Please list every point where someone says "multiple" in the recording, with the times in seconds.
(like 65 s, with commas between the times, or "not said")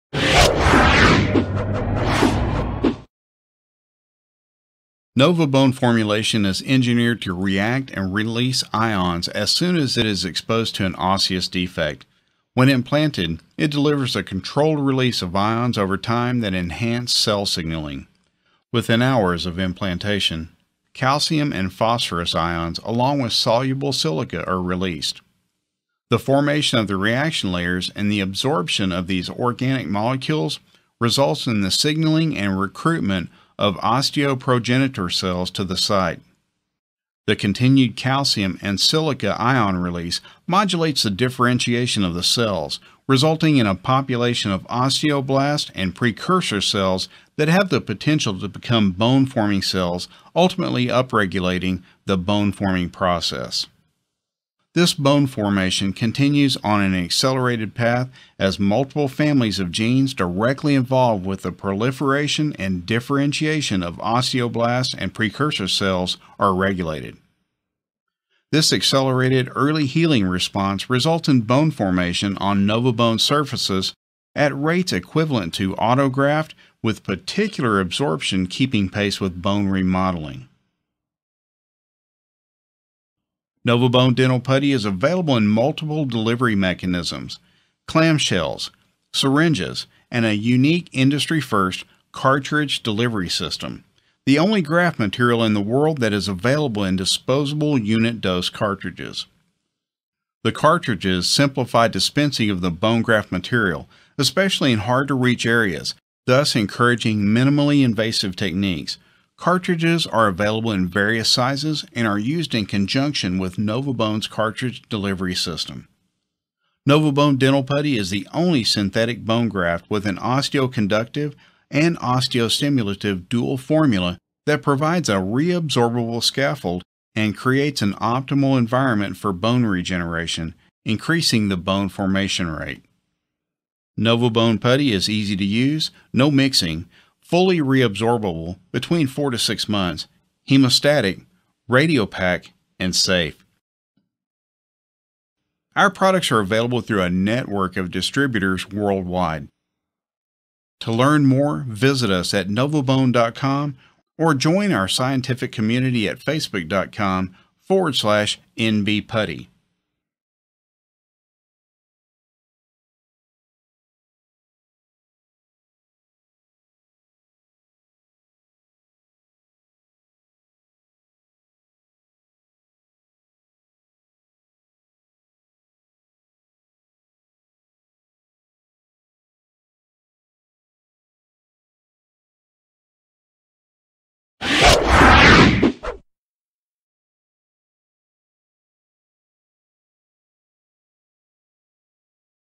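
58 s, 85 s.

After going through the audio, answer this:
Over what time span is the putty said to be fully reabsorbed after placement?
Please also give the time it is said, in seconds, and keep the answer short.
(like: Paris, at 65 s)
4 to 6 months, at 139 s.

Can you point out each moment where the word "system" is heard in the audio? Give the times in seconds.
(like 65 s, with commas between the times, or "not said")
93 s, 115 s.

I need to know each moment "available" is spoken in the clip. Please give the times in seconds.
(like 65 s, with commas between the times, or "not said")
84 s, 96 s, 110 s, 146 s.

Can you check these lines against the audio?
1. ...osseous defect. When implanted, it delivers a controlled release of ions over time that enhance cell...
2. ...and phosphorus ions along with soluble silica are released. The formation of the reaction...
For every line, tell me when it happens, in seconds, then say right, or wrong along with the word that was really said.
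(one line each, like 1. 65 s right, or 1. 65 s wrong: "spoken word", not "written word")
1. 10 s right
2. 21 s right.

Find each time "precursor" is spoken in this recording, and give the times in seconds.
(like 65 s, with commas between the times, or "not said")
45 s, 65 s.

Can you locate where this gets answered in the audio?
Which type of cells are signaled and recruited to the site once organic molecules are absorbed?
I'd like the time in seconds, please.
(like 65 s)
33 s.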